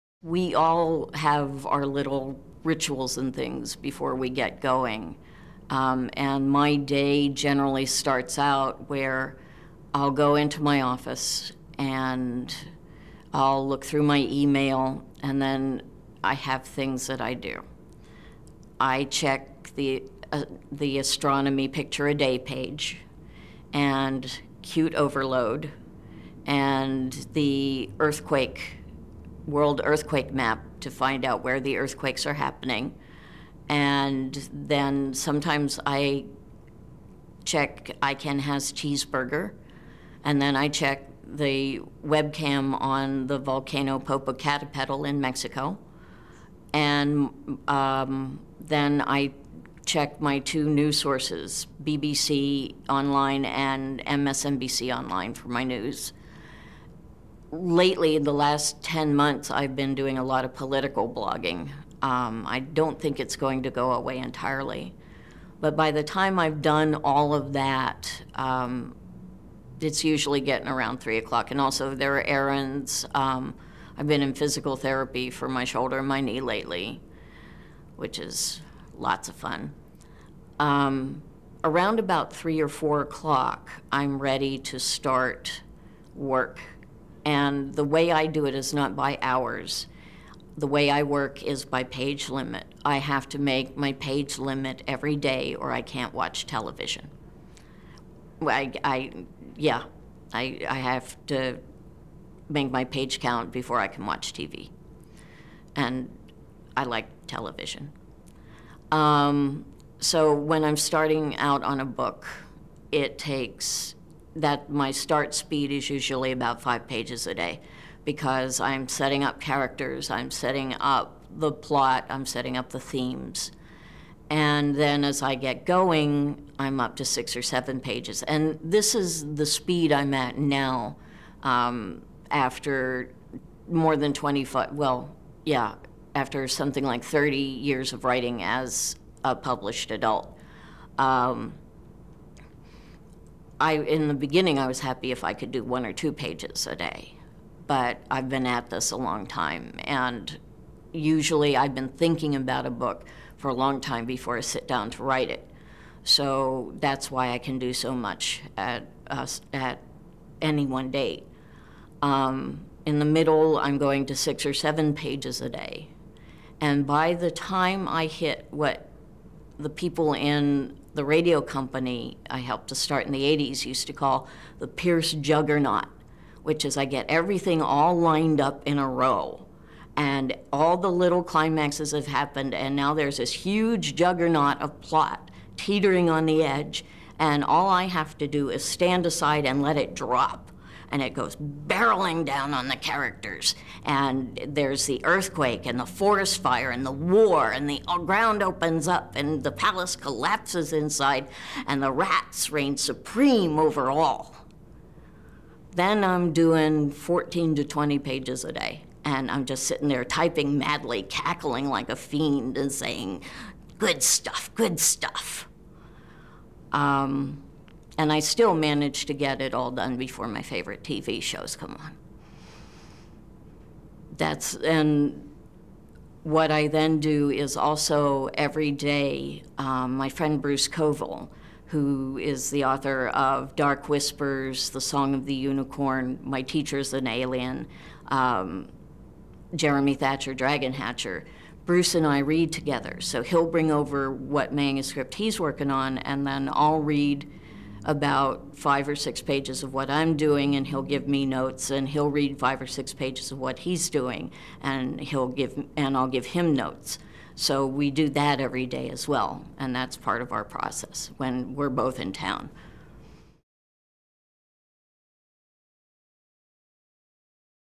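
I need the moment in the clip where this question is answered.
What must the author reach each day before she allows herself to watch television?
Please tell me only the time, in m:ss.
1:42.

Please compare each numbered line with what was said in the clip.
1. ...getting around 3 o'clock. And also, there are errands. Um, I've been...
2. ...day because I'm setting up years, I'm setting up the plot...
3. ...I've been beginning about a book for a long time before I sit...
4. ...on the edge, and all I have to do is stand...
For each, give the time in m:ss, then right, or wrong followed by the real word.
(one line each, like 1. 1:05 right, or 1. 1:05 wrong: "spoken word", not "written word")
1. 1:10 right
2. 1:57 wrong: "characters", not "years"
3. 2:31 wrong: "thinking", not "beginning"
4. 3:06 right.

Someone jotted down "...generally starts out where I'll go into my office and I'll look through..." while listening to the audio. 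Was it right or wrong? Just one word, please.
right.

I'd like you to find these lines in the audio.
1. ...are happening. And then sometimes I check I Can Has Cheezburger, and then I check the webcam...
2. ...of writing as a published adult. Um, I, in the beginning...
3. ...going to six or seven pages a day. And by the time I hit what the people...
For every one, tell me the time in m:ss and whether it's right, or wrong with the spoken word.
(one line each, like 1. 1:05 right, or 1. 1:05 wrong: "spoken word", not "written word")
1. 0:32 right
2. 2:17 right
3. 2:43 right.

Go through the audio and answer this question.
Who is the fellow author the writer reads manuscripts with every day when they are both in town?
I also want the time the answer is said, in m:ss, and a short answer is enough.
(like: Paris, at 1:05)
Bruce Coville, at 3:50.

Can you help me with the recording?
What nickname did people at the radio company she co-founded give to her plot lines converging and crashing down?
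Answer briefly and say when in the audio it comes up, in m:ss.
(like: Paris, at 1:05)
Pierce juggernaut, at 2:54.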